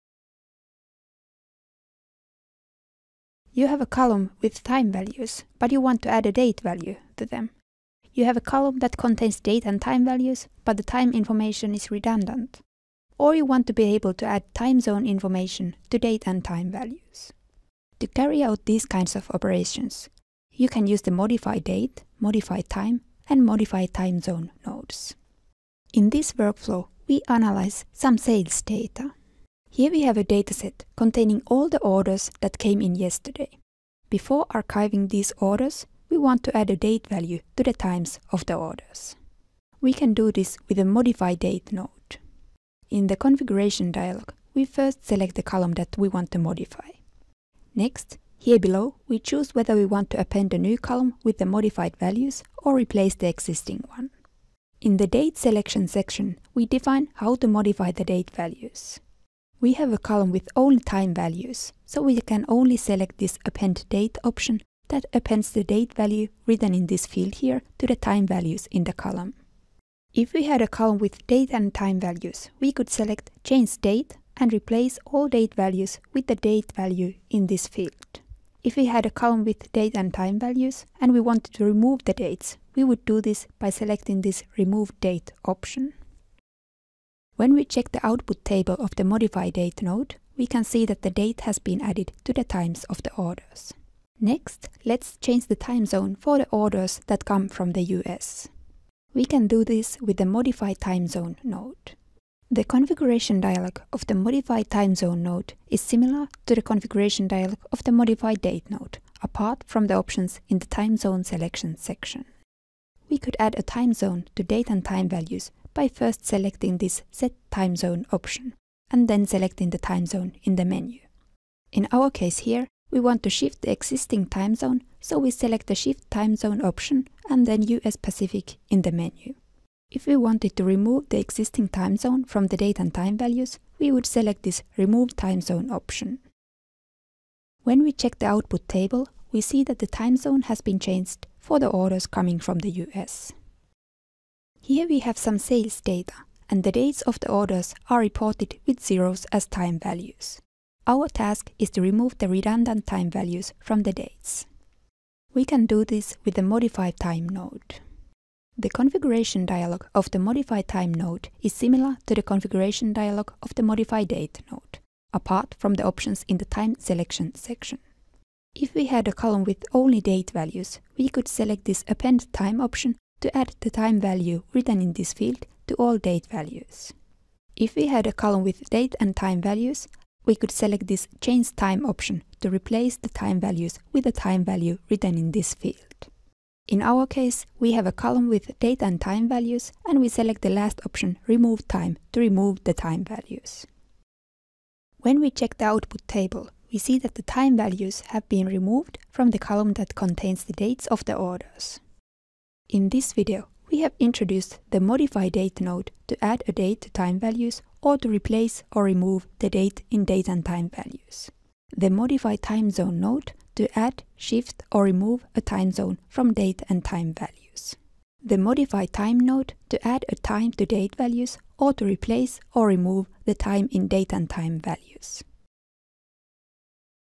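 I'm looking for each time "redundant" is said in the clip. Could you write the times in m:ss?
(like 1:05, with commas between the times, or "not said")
0:11, 2:32.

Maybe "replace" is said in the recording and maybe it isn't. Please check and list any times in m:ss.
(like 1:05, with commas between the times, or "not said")
0:52, 1:14, 3:02, 3:28, 3:41.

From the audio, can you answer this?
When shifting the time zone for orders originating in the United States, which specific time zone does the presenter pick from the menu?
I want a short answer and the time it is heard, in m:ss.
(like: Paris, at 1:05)
US Pacific, at 2:07.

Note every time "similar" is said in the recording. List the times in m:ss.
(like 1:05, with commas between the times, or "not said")
1:45, 2:41.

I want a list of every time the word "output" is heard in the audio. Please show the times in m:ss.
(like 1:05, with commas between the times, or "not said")
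1:28, 2:18, 3:15.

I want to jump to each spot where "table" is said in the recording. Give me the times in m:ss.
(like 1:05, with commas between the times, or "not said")
1:28, 2:18, 3:16.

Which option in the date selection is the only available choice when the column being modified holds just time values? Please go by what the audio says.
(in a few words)
Append date.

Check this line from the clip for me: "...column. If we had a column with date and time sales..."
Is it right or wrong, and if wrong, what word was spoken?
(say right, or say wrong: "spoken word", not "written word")
wrong: "values", not "sales".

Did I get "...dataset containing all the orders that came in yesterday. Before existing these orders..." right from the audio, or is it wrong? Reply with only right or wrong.
wrong.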